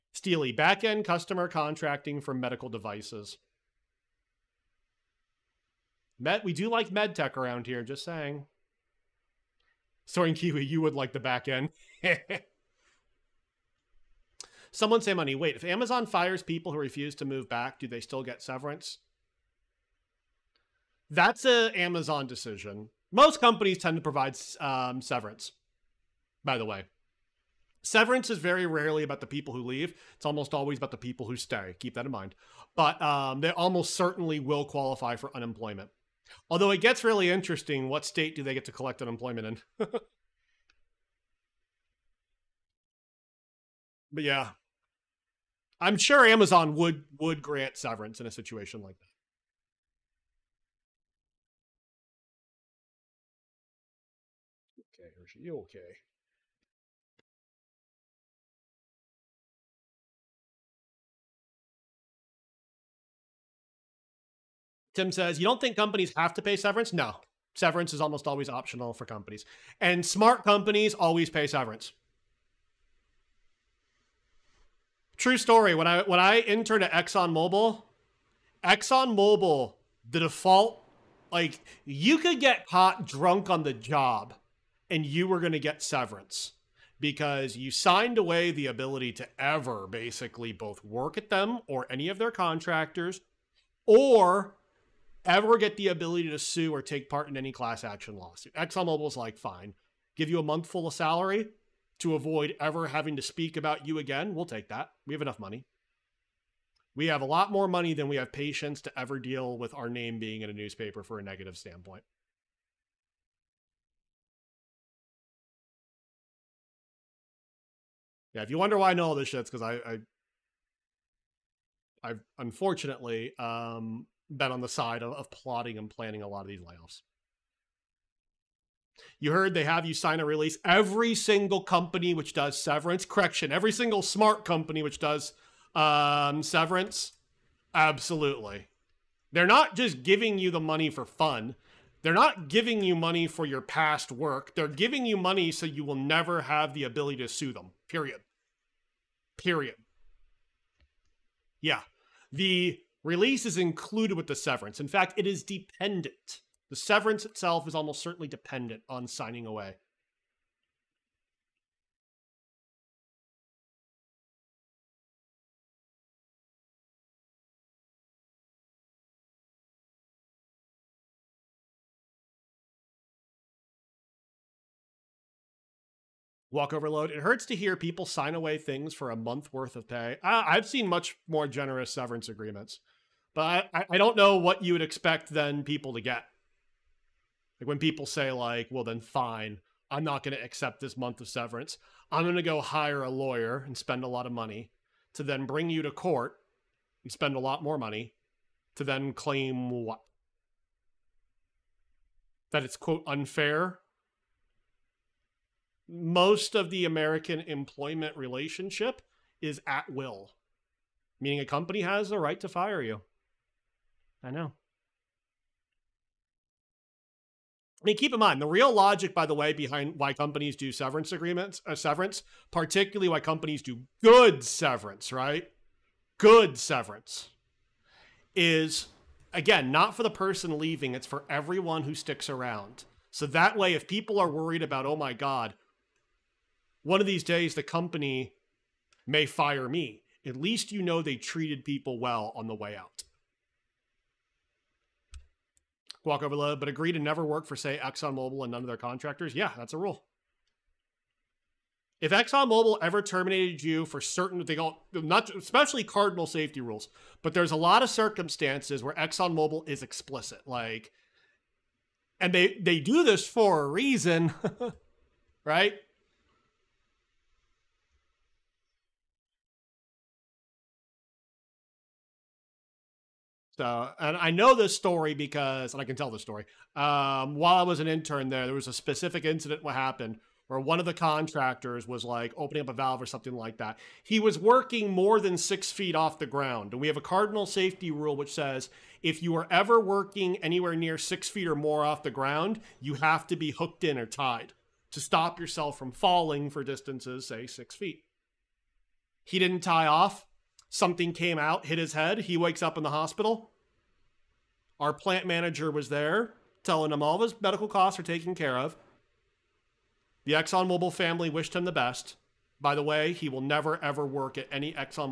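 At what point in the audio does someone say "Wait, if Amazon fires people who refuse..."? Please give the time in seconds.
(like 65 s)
15 s.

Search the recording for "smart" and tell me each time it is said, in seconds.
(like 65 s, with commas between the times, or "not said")
70 s, 134 s.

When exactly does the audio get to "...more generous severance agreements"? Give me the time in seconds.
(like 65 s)
181 s.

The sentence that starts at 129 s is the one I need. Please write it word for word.
You heard they have you sign a release.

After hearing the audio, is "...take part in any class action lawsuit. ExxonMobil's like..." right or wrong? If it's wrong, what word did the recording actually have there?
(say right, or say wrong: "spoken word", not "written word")
right.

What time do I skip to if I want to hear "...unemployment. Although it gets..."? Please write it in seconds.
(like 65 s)
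35 s.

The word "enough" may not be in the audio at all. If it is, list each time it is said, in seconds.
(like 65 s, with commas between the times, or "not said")
105 s.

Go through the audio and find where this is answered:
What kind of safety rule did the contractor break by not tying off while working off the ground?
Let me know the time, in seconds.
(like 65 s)
286 s.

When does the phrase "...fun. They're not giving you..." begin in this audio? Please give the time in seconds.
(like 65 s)
141 s.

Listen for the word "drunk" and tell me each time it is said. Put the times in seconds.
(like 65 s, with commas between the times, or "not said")
83 s.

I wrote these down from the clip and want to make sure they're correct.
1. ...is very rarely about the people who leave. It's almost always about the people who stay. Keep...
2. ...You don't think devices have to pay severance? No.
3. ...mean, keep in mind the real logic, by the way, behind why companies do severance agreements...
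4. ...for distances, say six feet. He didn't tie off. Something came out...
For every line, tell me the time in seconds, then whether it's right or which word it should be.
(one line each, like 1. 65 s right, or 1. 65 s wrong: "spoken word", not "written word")
1. 28 s right
2. 65 s wrong: "companies", not "devices"
3. 217 s right
4. 296 s right.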